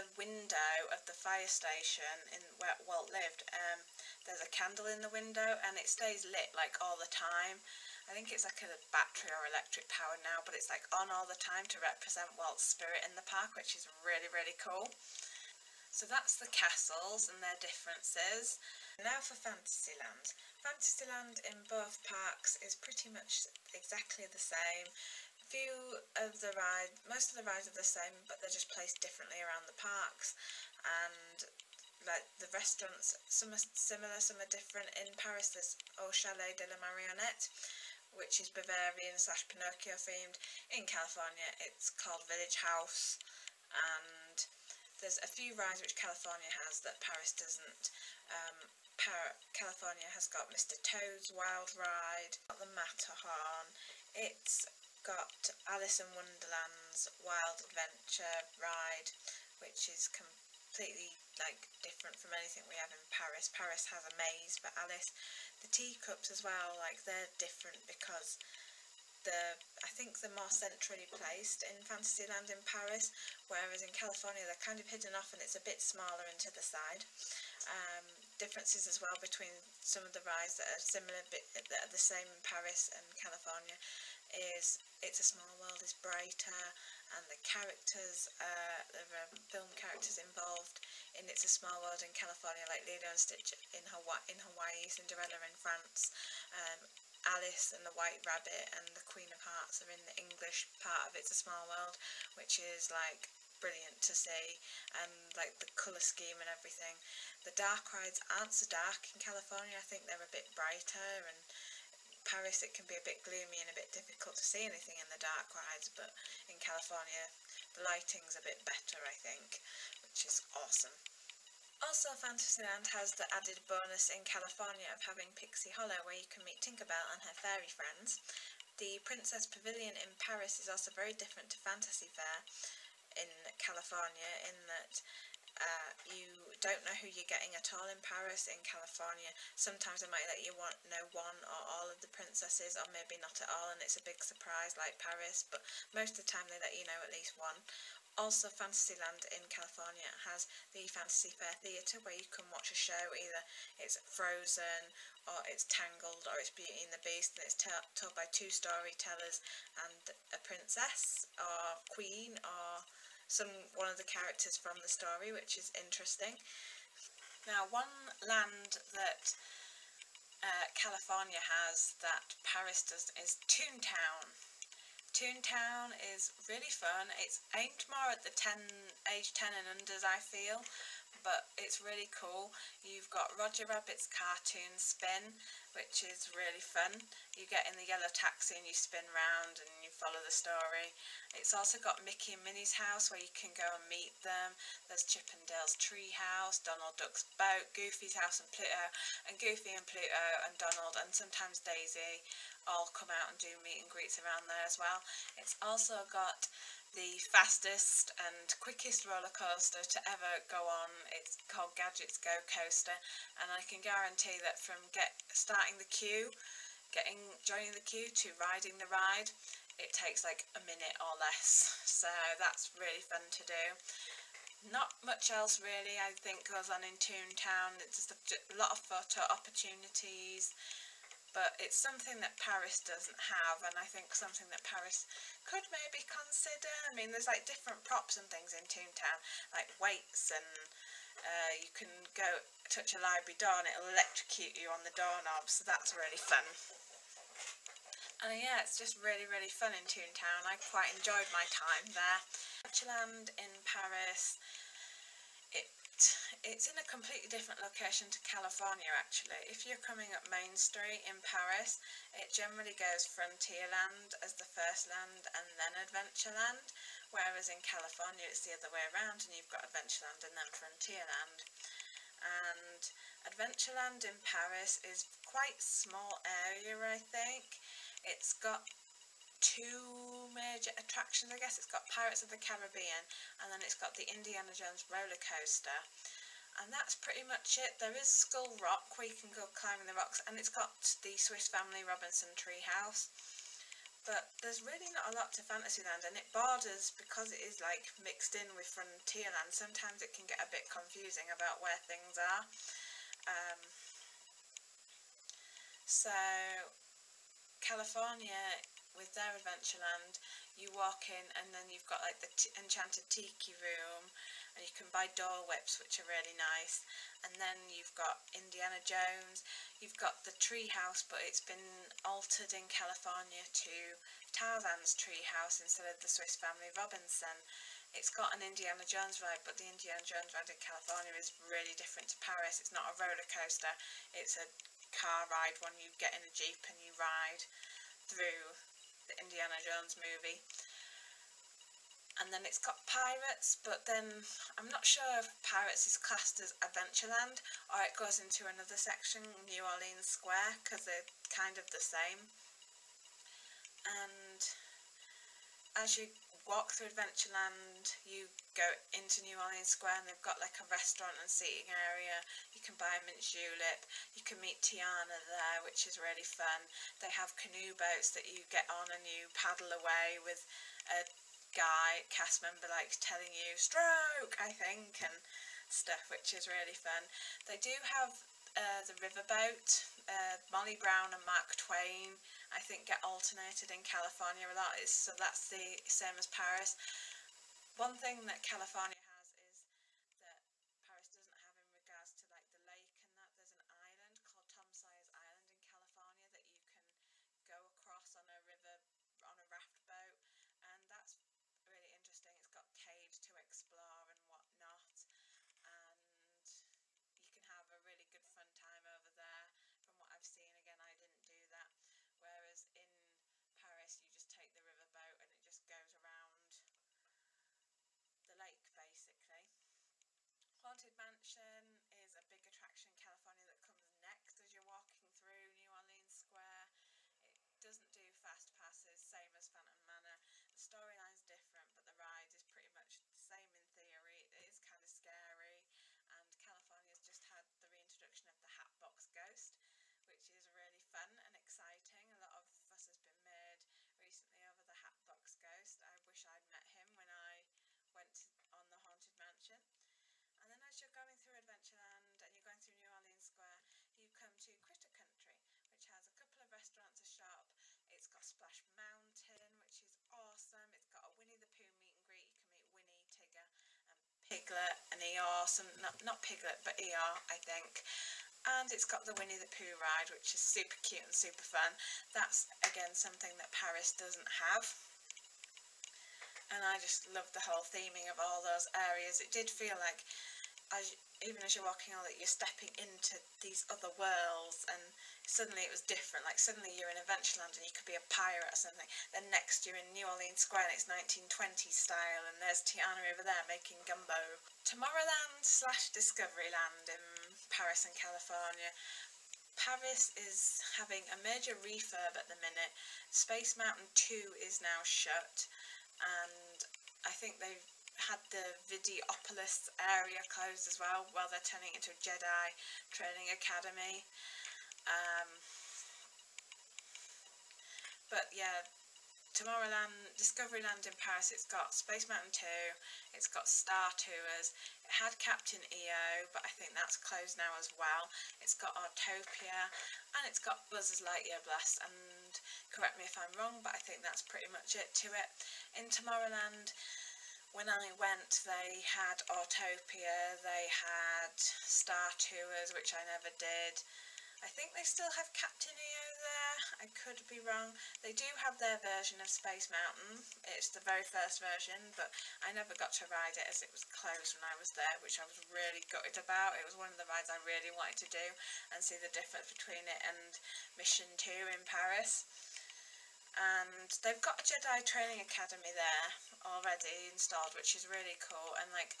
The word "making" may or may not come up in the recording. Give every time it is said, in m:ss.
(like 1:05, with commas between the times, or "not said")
8:13.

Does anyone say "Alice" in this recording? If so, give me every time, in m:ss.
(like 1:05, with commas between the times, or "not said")
0:55, 1:04, 1:37.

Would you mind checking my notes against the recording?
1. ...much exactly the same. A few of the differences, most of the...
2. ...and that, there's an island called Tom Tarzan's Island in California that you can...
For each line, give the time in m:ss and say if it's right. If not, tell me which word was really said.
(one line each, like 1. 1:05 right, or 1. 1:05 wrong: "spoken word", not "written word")
1. 0:23 wrong: "rides", not "differences"
2. 6:33 wrong: "Sawyer", not "Tarzan".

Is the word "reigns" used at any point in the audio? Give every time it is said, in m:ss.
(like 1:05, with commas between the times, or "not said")
not said.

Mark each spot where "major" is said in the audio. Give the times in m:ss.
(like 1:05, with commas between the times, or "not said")
4:40, 8:21.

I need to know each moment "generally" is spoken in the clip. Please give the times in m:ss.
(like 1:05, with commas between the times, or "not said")
4:22.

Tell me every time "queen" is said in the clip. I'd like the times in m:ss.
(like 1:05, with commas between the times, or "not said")
1:39, 2:41.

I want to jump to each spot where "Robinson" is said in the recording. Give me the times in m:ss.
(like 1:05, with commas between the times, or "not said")
4:51, 5:26.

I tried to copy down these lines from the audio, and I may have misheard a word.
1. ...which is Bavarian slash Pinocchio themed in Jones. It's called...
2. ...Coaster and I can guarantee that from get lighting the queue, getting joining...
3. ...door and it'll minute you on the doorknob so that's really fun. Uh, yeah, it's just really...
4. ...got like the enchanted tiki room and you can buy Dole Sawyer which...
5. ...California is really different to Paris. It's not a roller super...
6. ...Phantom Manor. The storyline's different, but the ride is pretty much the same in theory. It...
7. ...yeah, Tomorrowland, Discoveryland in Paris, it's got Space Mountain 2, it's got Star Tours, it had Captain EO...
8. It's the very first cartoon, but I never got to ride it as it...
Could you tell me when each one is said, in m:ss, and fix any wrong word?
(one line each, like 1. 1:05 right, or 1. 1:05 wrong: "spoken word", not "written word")
1. 0:38 wrong: "California", not "Jones"
2. 3:32 wrong: "starting", not "lighting"
3. 4:03 wrong: "electrocute", not "minute"
4. 5:11 wrong: "Whips", not "Sawyer"
5. 5:30 wrong: "coaster", not "super"
6. 7:09 right
7. 8:38 right
8. 9:10 wrong: "version", not "cartoon".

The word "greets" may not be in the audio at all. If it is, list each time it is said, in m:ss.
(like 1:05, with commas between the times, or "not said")
3:23, 7:42.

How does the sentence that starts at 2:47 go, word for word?
Now, one land that uh, California has that Paris does is Toontown.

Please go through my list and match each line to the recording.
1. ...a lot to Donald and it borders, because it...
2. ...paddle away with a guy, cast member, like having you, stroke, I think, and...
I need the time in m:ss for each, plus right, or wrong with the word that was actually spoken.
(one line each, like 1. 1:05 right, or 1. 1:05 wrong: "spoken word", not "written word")
1. 4:55 wrong: "Fantasyland", not "Donald"
2. 6:09 wrong: "telling", not "having".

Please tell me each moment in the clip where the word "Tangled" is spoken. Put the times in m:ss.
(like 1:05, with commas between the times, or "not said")
2:35.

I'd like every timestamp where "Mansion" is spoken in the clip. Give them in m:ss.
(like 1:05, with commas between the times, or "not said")
7:00, 7:29.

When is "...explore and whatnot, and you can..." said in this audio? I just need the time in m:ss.
6:43.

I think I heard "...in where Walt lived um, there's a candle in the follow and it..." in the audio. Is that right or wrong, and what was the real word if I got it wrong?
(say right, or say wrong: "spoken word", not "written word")
wrong: "window", not "follow".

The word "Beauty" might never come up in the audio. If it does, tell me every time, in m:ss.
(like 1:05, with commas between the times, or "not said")
2:36.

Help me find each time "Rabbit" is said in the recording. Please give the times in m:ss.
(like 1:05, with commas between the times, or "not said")
1:38, 3:03.